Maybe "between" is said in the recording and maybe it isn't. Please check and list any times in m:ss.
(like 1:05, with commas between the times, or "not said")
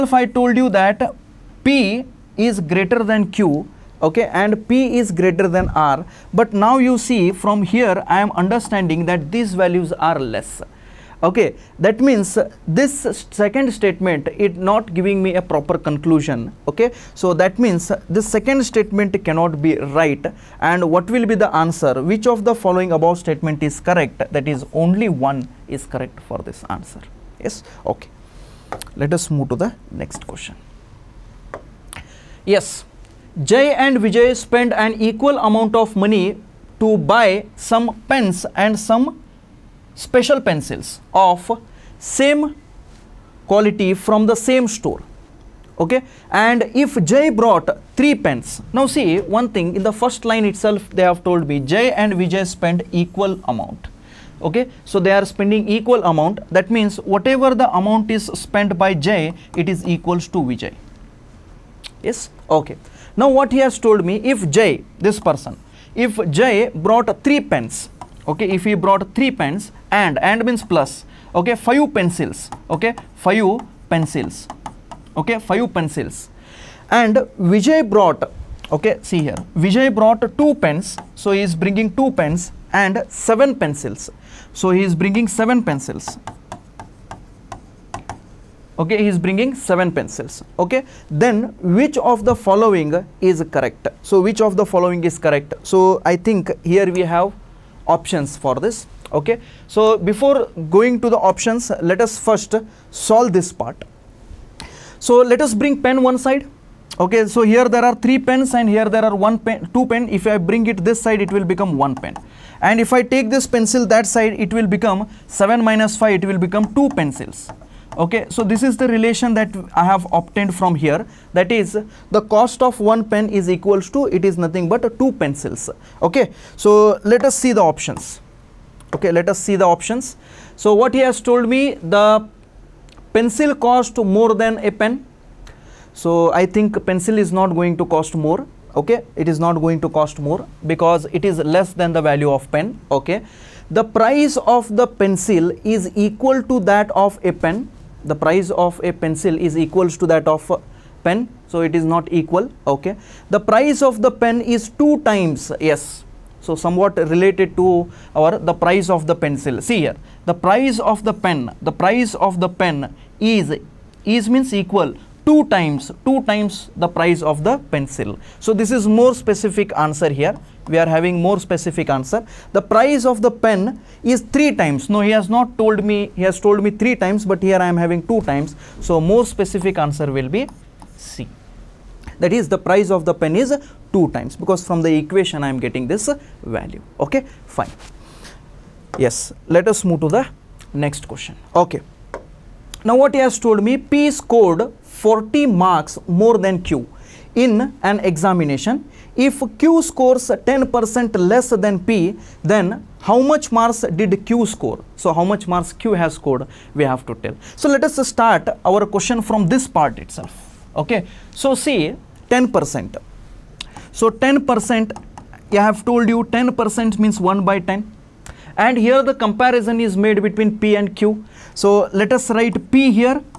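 3:40.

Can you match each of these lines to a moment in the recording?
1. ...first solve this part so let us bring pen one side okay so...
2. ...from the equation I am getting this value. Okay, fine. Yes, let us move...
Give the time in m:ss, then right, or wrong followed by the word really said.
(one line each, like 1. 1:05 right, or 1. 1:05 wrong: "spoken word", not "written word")
1. 1:42 right
2. 3:04 right.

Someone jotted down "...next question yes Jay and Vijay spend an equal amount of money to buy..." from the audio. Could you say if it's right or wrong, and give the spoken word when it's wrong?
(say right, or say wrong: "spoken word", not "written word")
right.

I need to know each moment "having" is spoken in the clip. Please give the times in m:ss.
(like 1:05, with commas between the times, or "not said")
2:50, 2:57.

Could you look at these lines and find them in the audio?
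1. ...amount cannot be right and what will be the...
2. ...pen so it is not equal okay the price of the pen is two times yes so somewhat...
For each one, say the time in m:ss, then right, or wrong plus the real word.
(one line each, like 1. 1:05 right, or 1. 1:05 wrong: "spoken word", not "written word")
1. 0:18 wrong: "statement", not "amount"
2. 2:31 right.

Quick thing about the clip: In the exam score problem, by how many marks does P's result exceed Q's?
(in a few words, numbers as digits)
40.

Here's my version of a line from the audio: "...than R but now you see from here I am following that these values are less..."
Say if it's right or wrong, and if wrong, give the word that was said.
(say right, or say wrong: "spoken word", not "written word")
wrong: "understanding", not "following".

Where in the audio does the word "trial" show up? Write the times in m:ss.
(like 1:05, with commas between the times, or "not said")
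not said.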